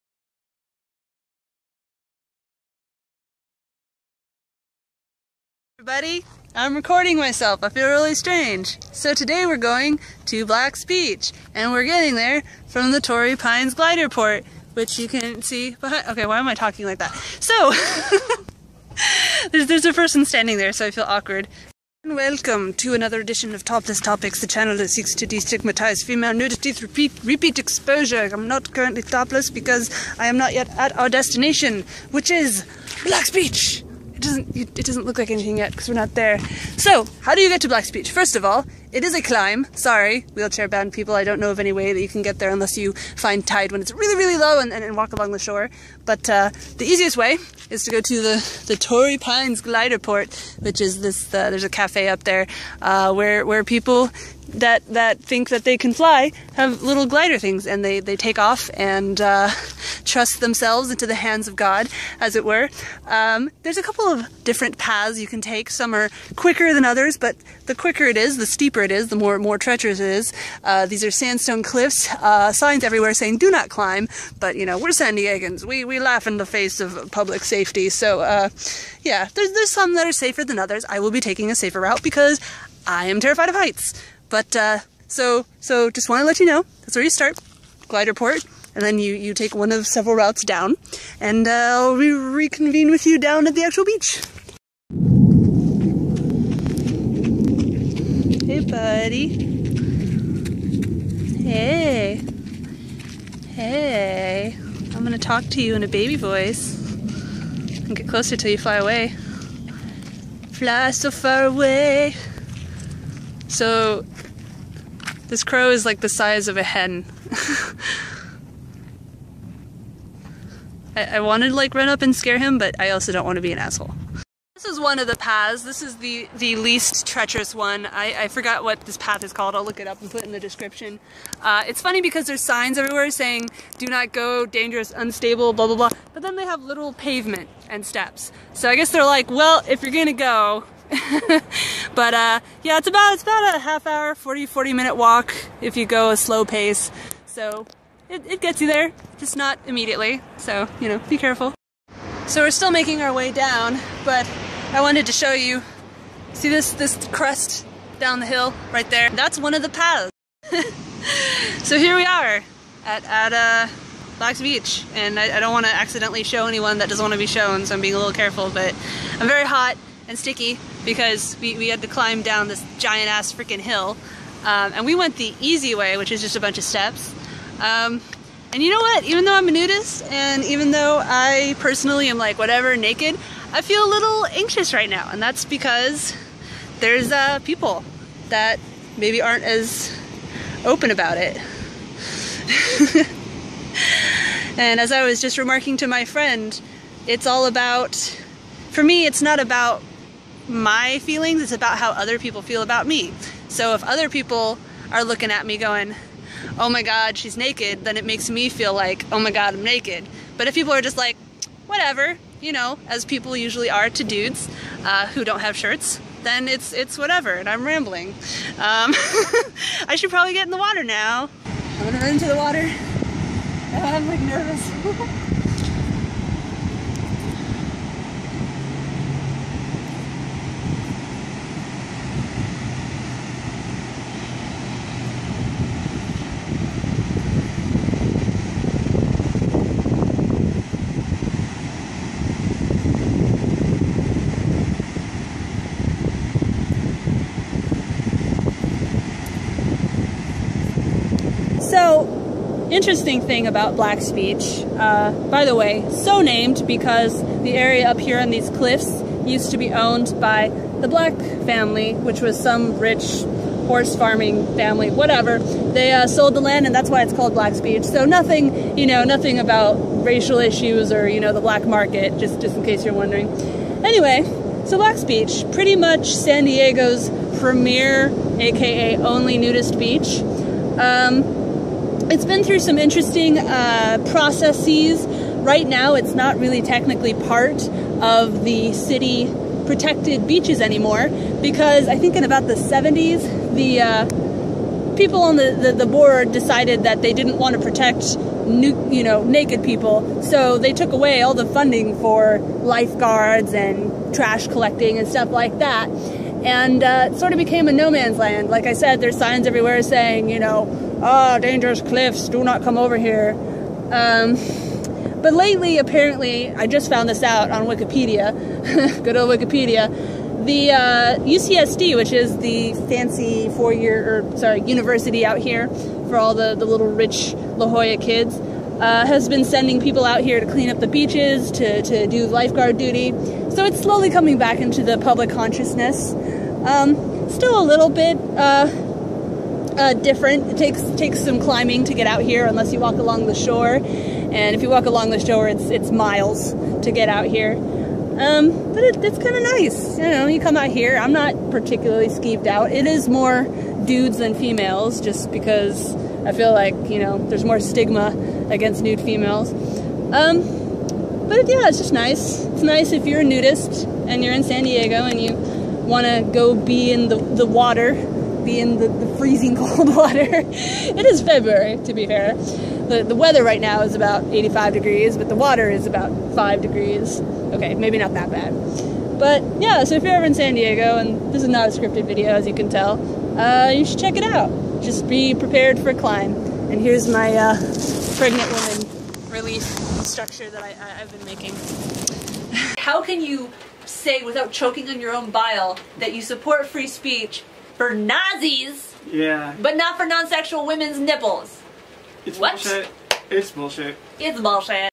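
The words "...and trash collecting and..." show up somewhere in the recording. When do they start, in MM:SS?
05:03.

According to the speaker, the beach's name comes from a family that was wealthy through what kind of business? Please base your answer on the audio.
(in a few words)
horse farming.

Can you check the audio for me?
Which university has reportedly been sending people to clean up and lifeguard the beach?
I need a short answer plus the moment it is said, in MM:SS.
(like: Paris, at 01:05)
UCSD, at 05:21.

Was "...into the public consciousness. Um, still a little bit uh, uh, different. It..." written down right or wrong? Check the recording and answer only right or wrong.
right.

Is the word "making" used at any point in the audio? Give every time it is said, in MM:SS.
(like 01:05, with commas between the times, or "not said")
02:32, 06:31.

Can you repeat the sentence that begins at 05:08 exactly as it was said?
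Like I said, there's signs everywhere saying, you know, ah, oh, dangerous cliffs, do not come over here.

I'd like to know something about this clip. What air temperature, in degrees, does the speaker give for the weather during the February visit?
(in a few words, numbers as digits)
85 degrees.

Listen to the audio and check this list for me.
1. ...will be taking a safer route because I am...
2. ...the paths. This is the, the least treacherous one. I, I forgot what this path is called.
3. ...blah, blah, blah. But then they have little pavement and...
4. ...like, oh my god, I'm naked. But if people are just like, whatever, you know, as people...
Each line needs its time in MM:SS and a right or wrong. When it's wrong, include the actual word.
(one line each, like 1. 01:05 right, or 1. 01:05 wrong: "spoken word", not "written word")
1. 01:20 right
2. 02:05 right
3. 02:15 right
4. 03:28 right.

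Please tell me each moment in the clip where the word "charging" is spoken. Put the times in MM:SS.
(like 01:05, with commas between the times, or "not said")
not said.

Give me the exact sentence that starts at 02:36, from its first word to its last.
See this this crest down the hill right there?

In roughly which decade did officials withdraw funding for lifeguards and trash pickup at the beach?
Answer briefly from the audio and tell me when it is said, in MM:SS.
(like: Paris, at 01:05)
the 70s, at 04:52.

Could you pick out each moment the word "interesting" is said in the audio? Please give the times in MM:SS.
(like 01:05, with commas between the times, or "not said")
04:12, 04:42.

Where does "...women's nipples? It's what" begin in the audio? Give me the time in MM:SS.
06:40.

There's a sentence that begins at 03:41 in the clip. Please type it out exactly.
I'm gonna run into the water.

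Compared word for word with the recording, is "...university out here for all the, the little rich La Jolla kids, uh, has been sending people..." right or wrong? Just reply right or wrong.
right.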